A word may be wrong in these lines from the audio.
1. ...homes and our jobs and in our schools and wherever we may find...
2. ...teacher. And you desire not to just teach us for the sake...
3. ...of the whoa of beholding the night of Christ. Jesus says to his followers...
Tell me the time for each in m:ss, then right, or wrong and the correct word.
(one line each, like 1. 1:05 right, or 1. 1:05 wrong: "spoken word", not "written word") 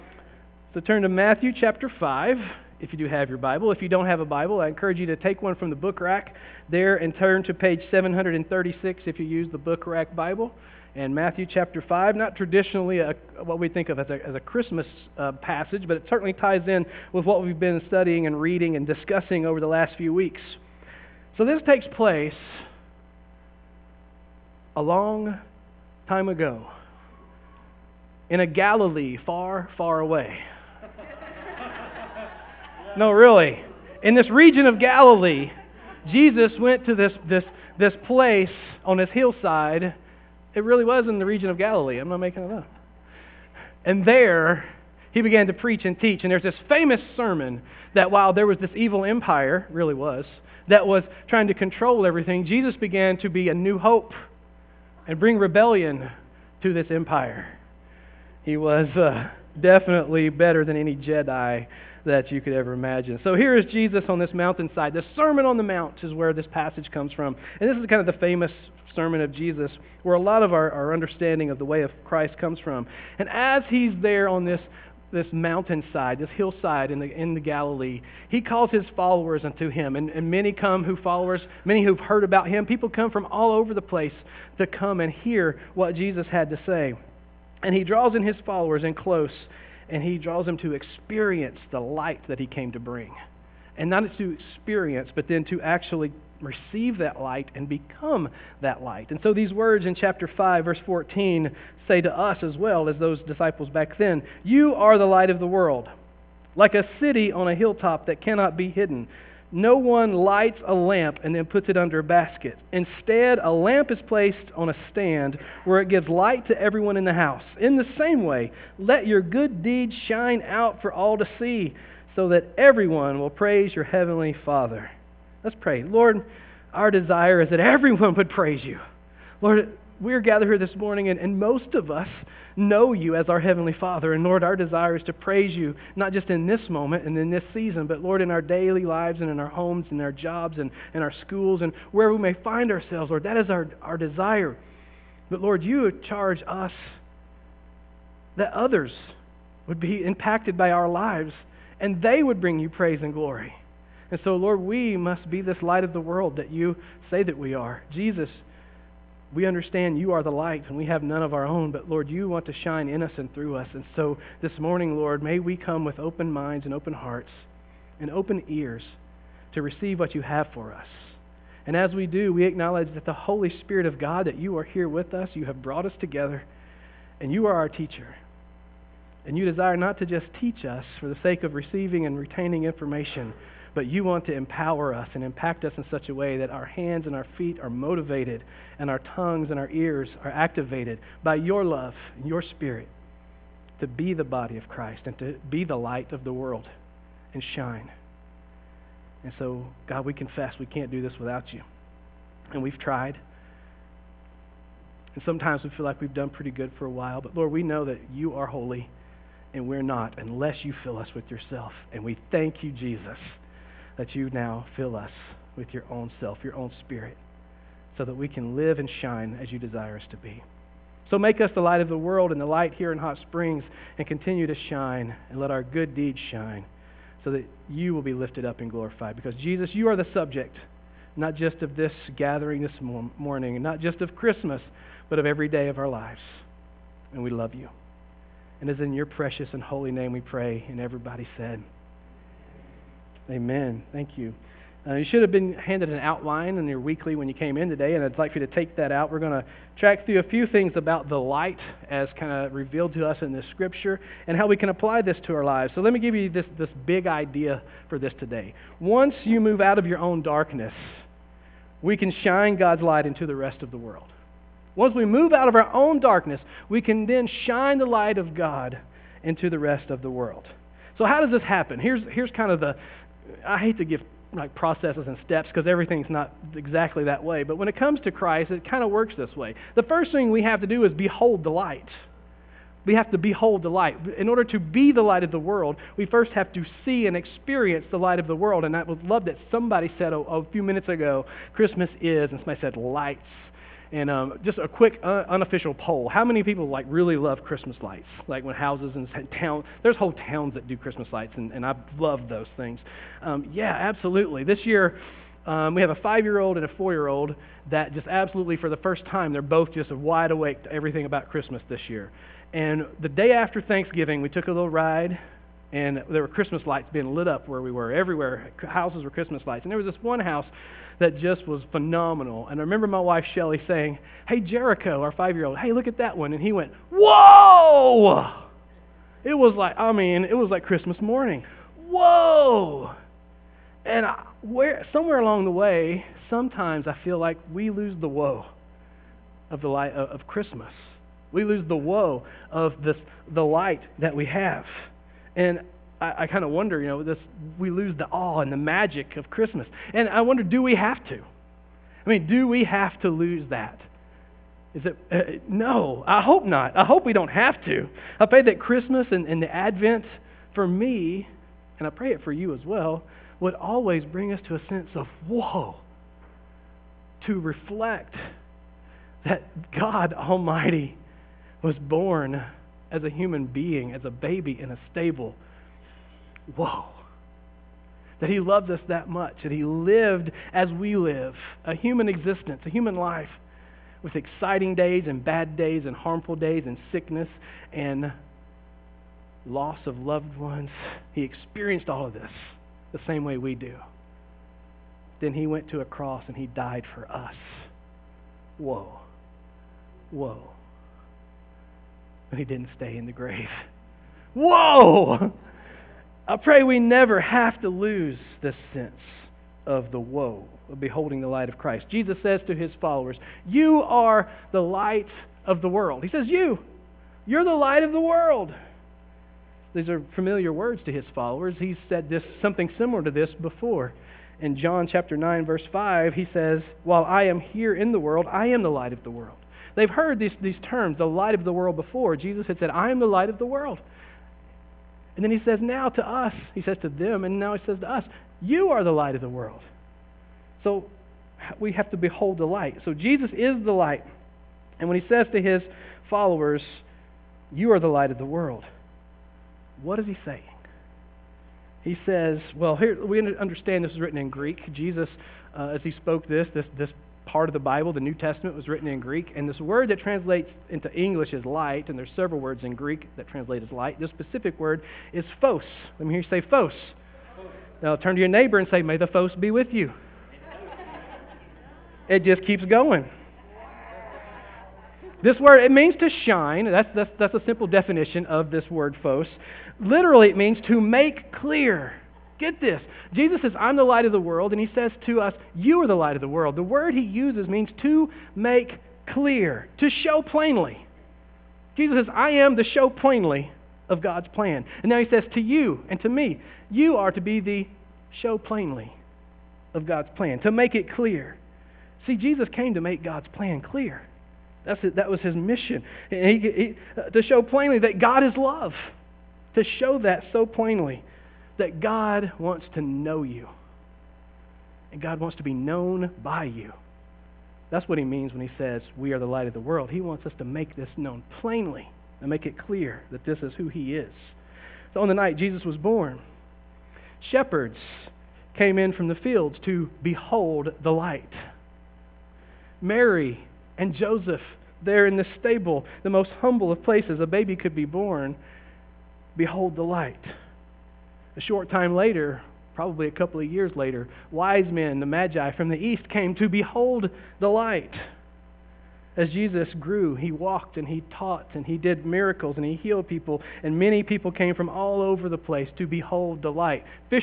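1. 2:19 right
2. 2:57 right
3. 6:49 wrong: "light", not "night".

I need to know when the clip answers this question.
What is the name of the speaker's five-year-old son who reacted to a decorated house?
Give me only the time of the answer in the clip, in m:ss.
5:24.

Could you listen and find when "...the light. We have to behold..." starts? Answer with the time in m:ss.
4:41.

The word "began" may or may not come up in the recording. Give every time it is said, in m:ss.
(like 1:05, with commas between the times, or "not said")
0:45, 0:52.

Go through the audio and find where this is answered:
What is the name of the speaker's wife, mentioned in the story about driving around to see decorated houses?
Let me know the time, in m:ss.
5:23.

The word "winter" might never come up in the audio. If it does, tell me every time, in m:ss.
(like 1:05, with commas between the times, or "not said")
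not said.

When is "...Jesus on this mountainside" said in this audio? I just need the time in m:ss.
1:03.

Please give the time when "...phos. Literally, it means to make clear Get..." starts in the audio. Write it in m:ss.
7:59.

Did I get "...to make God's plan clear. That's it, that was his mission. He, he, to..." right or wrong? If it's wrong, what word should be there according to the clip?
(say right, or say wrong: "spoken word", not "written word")
right.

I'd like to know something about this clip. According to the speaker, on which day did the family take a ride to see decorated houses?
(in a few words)
Day after Thanksgiving.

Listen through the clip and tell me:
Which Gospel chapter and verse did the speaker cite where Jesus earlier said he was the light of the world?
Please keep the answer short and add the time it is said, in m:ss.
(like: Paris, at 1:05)
John 9:5, at 7:04.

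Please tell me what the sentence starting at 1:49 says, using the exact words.
No one lights a lamp and then puts it under a basket.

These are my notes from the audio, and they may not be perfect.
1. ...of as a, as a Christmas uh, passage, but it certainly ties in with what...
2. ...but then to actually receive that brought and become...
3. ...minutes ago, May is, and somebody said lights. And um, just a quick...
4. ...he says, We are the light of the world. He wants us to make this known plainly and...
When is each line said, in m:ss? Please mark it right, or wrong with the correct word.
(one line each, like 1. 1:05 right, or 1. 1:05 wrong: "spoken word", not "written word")
1. 0:13 right
2. 1:35 wrong: "light", not "brought"
3. 4:50 wrong: "Christmas", not "May"
4. 8:38 right.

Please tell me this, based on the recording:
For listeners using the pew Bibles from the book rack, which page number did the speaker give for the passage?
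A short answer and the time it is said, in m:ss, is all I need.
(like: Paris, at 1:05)
736, at 0:07.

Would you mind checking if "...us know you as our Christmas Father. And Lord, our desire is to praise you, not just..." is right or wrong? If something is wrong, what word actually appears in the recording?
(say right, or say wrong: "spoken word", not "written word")
wrong: "Heavenly", not "Christmas".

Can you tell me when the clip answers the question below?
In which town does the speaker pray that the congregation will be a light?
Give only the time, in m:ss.
3:42.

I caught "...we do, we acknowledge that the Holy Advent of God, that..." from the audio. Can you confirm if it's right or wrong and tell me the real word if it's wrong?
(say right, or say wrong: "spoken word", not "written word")
wrong: "Spirit", not "Advent".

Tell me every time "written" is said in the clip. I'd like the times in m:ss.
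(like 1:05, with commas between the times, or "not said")
7:33, 7:38.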